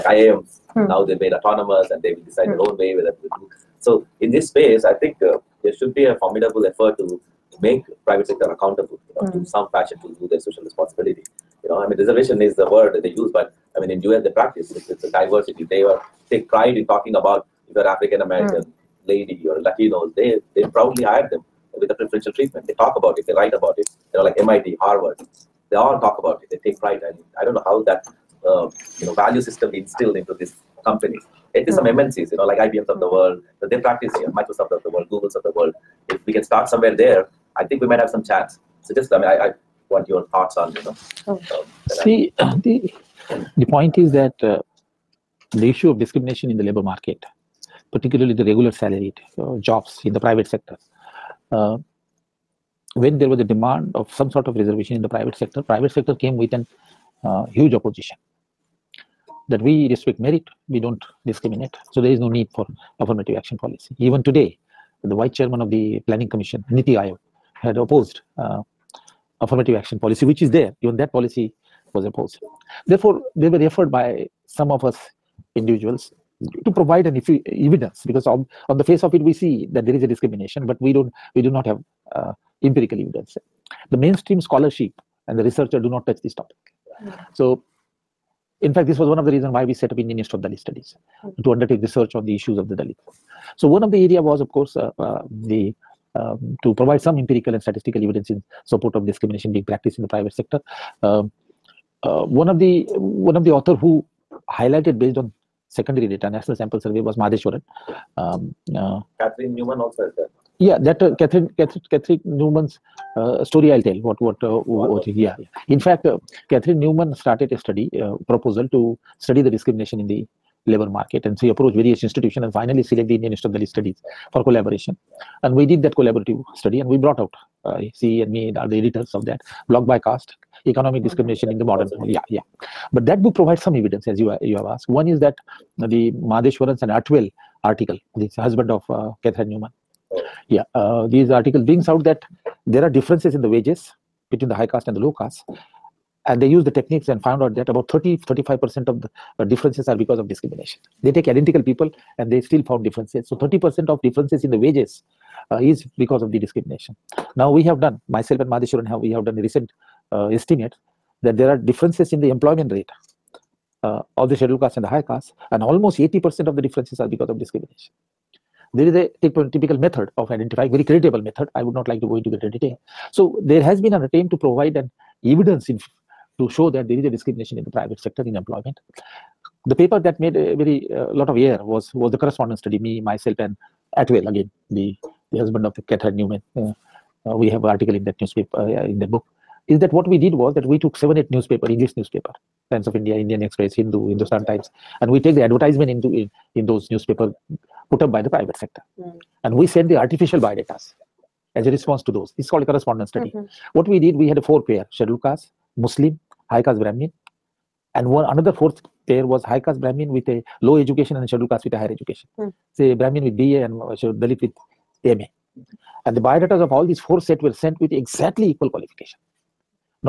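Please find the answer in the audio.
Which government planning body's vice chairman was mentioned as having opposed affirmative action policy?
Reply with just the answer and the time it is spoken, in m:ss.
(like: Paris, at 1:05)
NITI Aayog, at 1:06.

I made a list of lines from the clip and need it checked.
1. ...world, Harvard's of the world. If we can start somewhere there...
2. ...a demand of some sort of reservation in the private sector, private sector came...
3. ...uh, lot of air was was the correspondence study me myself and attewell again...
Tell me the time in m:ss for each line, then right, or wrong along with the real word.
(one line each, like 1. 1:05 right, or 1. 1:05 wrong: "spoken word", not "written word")
1. 0:34 wrong: "Google", not "Harvard"
2. 0:53 right
3. 3:00 right.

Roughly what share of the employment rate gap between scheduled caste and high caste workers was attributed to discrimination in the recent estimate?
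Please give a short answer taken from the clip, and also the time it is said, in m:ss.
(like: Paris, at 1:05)
80%, at 2:45.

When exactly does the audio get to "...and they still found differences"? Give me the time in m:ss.
2:32.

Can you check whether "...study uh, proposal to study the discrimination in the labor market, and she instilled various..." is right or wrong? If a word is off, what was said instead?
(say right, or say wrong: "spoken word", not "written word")
wrong: "approached", not "instilled".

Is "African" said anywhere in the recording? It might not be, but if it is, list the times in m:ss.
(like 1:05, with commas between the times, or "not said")
0:17.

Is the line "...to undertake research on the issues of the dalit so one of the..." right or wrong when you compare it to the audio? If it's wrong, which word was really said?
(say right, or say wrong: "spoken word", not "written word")
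right.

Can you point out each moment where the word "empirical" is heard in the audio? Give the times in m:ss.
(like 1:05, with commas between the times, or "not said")
1:22, 1:37.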